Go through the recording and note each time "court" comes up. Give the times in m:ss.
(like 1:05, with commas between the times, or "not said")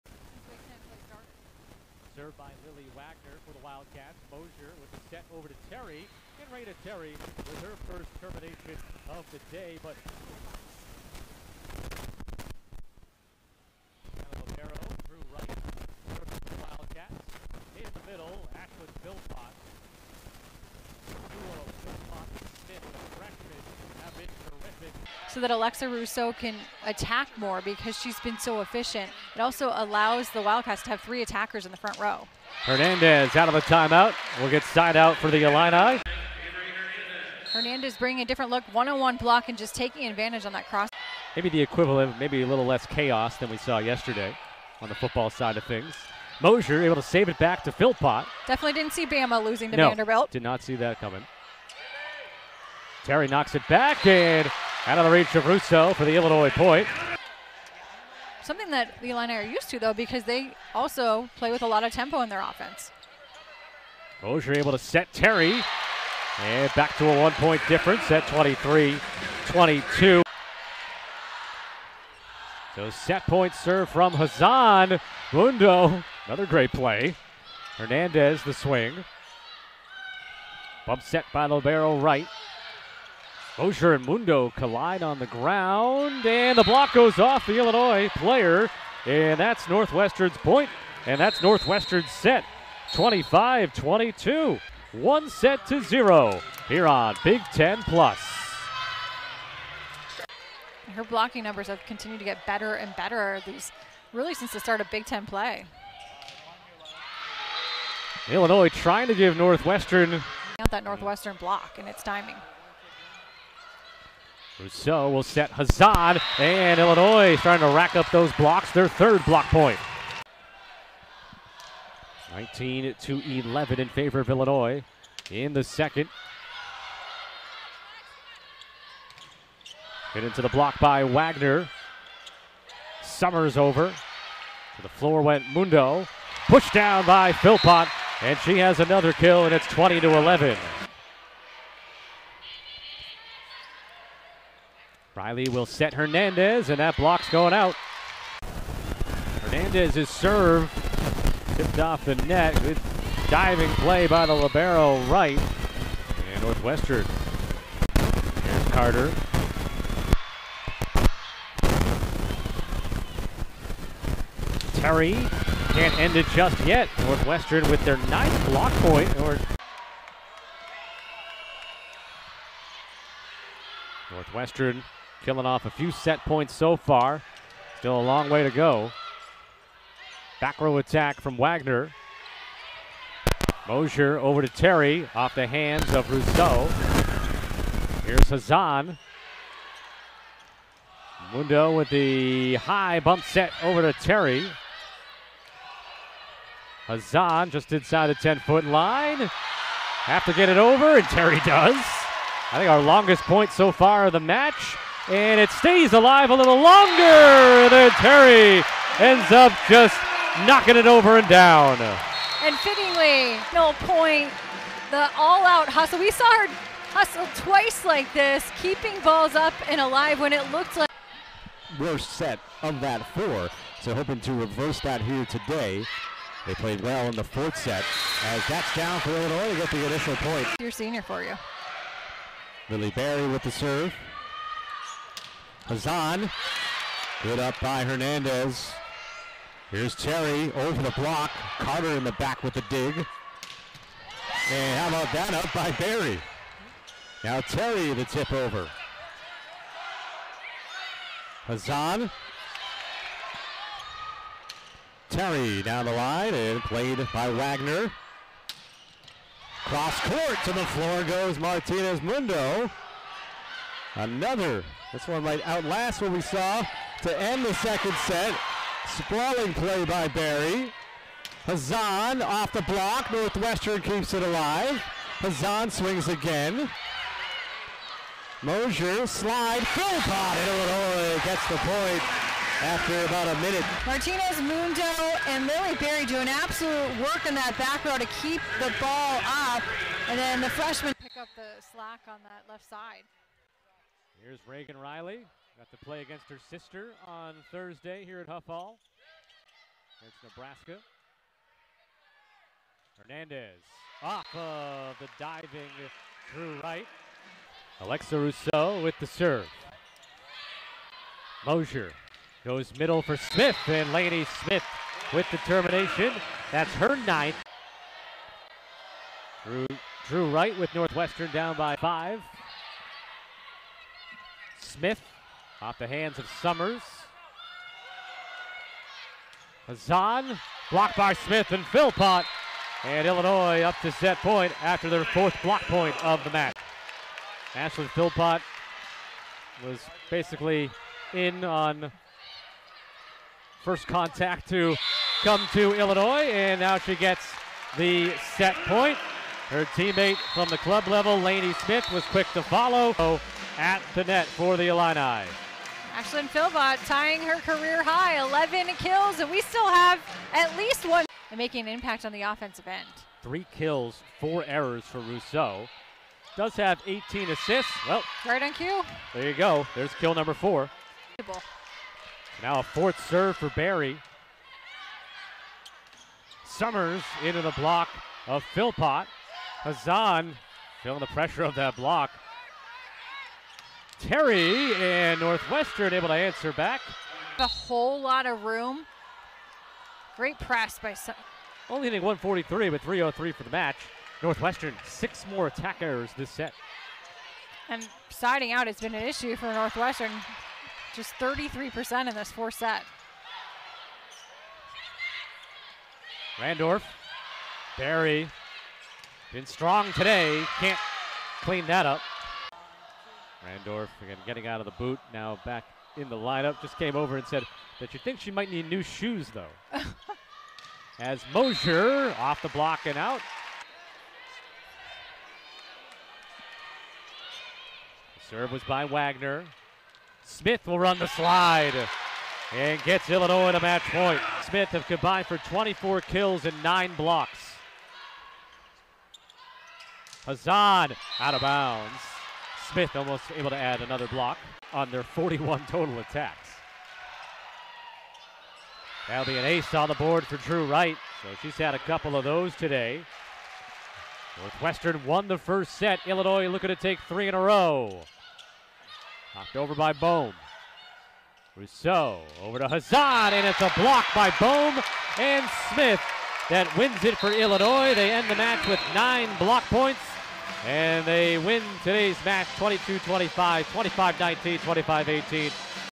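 4:20.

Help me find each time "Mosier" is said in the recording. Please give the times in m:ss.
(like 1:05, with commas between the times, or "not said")
0:04, 0:46, 1:04, 3:03, 4:38, 5:11, 7:01.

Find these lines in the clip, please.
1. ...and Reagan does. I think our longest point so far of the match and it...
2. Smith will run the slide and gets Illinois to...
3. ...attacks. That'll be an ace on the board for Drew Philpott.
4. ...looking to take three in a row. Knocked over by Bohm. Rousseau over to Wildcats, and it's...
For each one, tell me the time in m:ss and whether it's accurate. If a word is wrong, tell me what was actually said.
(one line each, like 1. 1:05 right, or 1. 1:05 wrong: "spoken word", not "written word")
1. 3:20 wrong: "Terry", not "Reagan"
2. 7:10 right
3. 7:25 wrong: "Wright", not "Philpott"
4. 7:36 wrong: "Hazan", not "Wildcats".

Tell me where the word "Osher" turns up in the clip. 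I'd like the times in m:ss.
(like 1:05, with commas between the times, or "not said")
1:23.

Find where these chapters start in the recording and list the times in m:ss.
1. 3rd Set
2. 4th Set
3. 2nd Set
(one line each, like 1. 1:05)
1. 3:41
2. 6:01
3. 1:40.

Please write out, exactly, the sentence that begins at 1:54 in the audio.
Rousseau will set Hazan, and Illinois is trying to rack up those blocks, their third block point.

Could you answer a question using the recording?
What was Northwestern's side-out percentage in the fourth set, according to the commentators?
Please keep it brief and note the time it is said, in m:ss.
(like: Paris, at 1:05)
33%, at 6:41.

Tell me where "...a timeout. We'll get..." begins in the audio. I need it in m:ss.
0:33.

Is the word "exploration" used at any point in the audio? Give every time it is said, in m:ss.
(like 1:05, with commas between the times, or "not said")
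not said.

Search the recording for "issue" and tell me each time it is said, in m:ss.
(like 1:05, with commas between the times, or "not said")
6:39.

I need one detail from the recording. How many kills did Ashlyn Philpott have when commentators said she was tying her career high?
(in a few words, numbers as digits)
11.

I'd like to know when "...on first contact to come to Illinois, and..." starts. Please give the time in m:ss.
5:41.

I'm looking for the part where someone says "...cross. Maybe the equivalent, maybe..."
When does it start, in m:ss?
0:40.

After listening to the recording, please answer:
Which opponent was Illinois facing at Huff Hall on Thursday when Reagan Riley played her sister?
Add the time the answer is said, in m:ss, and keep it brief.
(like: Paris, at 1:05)
Nebraska, at 5:00.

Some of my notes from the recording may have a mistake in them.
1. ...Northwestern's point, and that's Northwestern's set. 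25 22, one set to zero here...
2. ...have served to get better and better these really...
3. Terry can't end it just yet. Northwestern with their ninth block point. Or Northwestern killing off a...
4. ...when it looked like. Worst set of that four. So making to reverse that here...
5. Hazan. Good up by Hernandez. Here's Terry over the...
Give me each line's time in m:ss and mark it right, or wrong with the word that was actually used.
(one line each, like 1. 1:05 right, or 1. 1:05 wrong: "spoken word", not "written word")
1. 1:29 right
2. 1:41 wrong: "continued", not "served"
3. 2:44 right
4. 3:40 wrong: "hoping", not "making"
5. 3:55 right.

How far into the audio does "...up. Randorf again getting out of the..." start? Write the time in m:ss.
6:51.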